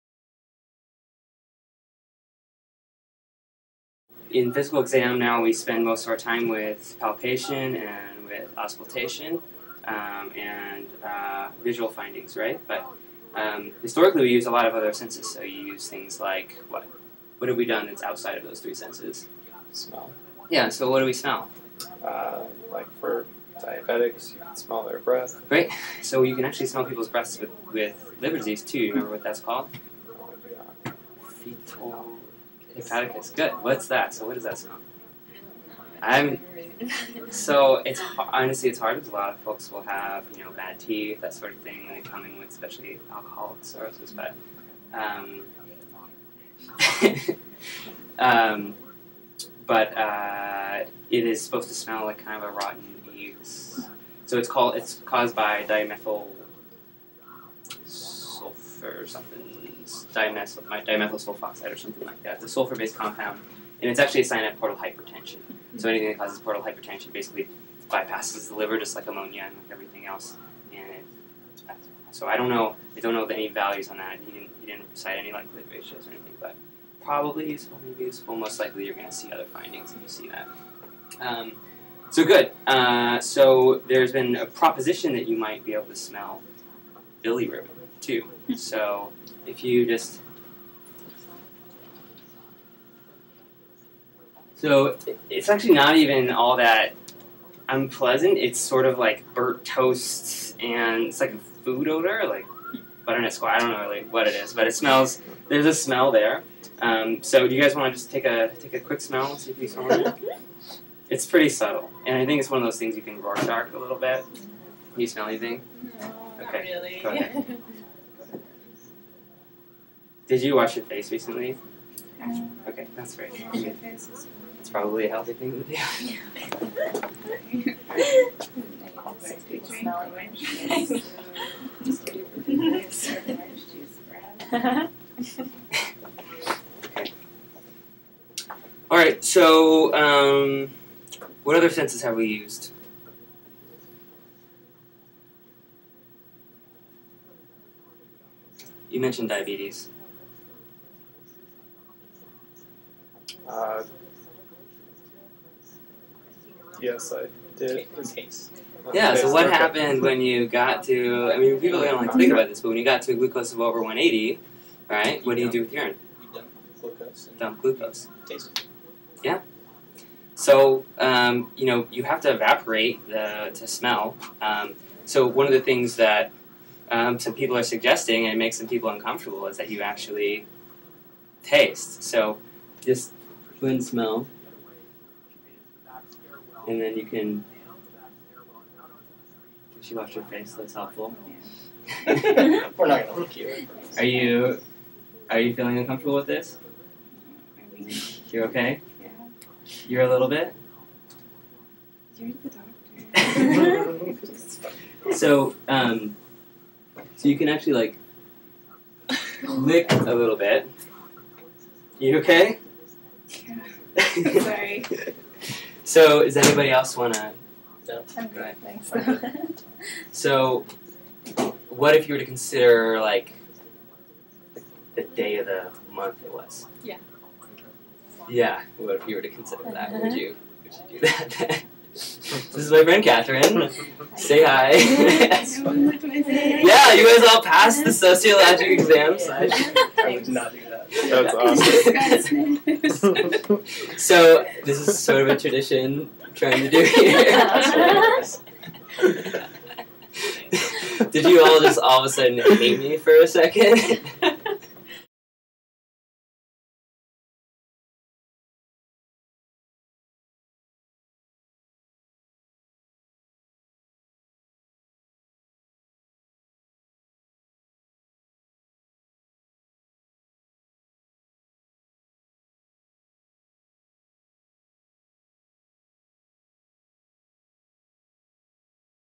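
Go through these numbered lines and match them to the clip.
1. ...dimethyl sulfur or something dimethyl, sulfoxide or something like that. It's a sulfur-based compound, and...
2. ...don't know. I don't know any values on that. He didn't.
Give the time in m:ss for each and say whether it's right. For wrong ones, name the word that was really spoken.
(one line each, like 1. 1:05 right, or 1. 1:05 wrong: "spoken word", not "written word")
1. 0:55 right
2. 1:12 right.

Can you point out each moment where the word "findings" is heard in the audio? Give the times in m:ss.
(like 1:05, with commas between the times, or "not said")
0:11, 1:19.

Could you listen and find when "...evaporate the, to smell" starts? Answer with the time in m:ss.
2:52.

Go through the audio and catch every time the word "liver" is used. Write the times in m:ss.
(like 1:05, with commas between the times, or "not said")
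0:28, 1:08.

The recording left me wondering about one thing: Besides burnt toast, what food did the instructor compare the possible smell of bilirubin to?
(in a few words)
butternut squash.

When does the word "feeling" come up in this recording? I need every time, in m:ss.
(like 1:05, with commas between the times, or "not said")
3:15.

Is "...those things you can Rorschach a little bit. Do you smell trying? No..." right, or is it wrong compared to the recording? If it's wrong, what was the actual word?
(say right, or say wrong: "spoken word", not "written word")
wrong: "anything", not "trying".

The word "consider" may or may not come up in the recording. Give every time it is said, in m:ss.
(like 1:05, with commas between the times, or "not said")
3:42, 3:49.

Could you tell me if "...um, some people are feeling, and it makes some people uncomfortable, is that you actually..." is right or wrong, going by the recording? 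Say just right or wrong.
wrong.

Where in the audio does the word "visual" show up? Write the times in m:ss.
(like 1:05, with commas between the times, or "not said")
0:11.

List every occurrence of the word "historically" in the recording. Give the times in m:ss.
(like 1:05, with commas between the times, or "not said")
0:13.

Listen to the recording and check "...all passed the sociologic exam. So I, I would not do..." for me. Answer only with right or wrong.
right.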